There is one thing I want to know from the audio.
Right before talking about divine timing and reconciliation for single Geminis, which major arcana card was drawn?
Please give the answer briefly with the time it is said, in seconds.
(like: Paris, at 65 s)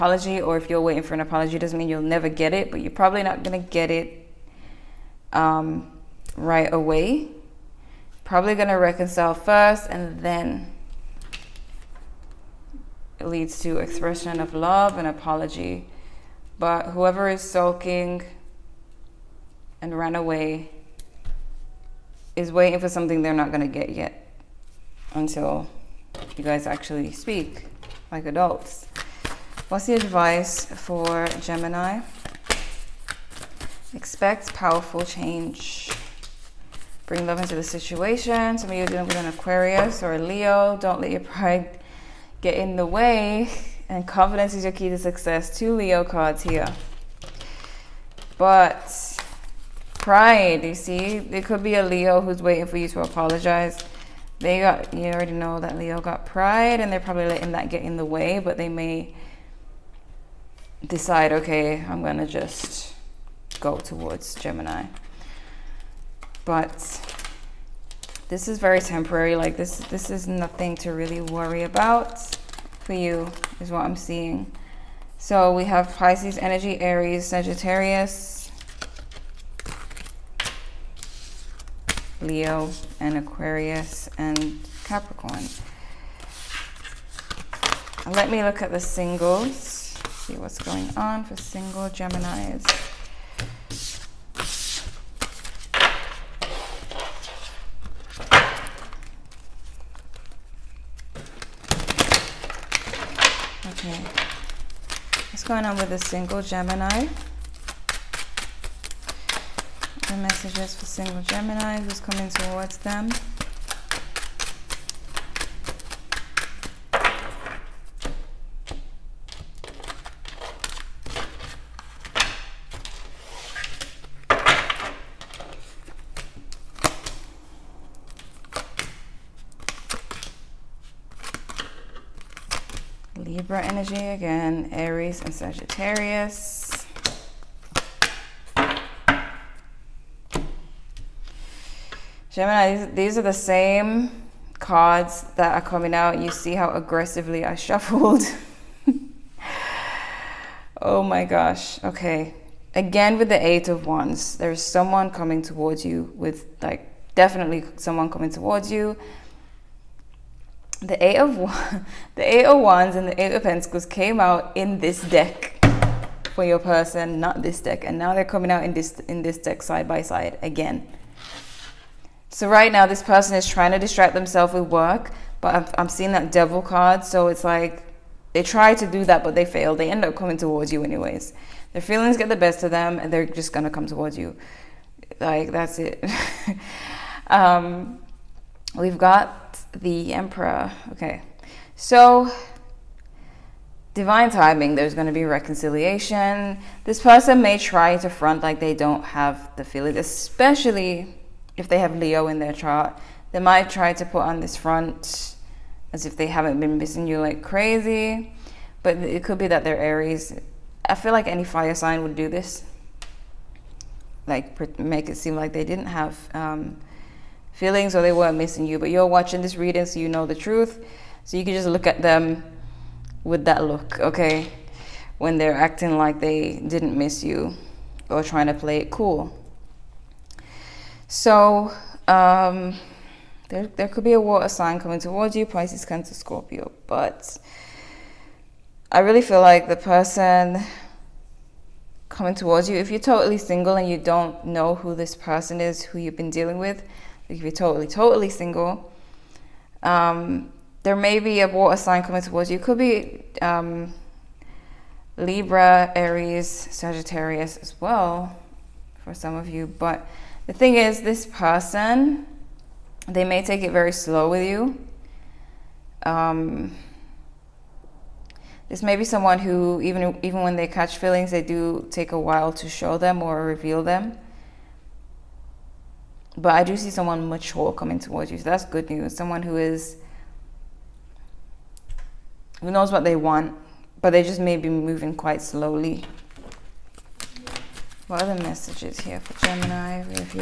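the Emperor, at 189 s.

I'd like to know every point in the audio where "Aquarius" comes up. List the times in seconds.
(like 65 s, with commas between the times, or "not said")
39 s, 83 s.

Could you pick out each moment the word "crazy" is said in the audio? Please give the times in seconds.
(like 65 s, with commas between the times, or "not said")
207 s.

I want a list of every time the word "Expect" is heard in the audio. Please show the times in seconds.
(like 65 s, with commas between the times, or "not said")
33 s.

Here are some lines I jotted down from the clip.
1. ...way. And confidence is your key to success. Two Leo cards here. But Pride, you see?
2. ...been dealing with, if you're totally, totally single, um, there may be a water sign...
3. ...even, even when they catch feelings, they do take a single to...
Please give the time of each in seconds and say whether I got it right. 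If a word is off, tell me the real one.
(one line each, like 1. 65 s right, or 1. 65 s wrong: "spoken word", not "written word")
1. 42 s right
2. 246 s right
3. 269 s wrong: "while", not "single".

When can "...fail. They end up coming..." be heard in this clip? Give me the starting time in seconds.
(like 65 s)
179 s.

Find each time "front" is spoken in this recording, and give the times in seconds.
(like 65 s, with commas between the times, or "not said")
198 s, 204 s.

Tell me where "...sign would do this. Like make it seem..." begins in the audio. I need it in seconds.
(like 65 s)
211 s.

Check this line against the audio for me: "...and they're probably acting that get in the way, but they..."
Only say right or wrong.
wrong.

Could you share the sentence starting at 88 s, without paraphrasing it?
Let me look at the singles, see what's going on for single Geminis.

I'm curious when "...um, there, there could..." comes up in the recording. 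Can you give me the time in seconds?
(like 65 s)
232 s.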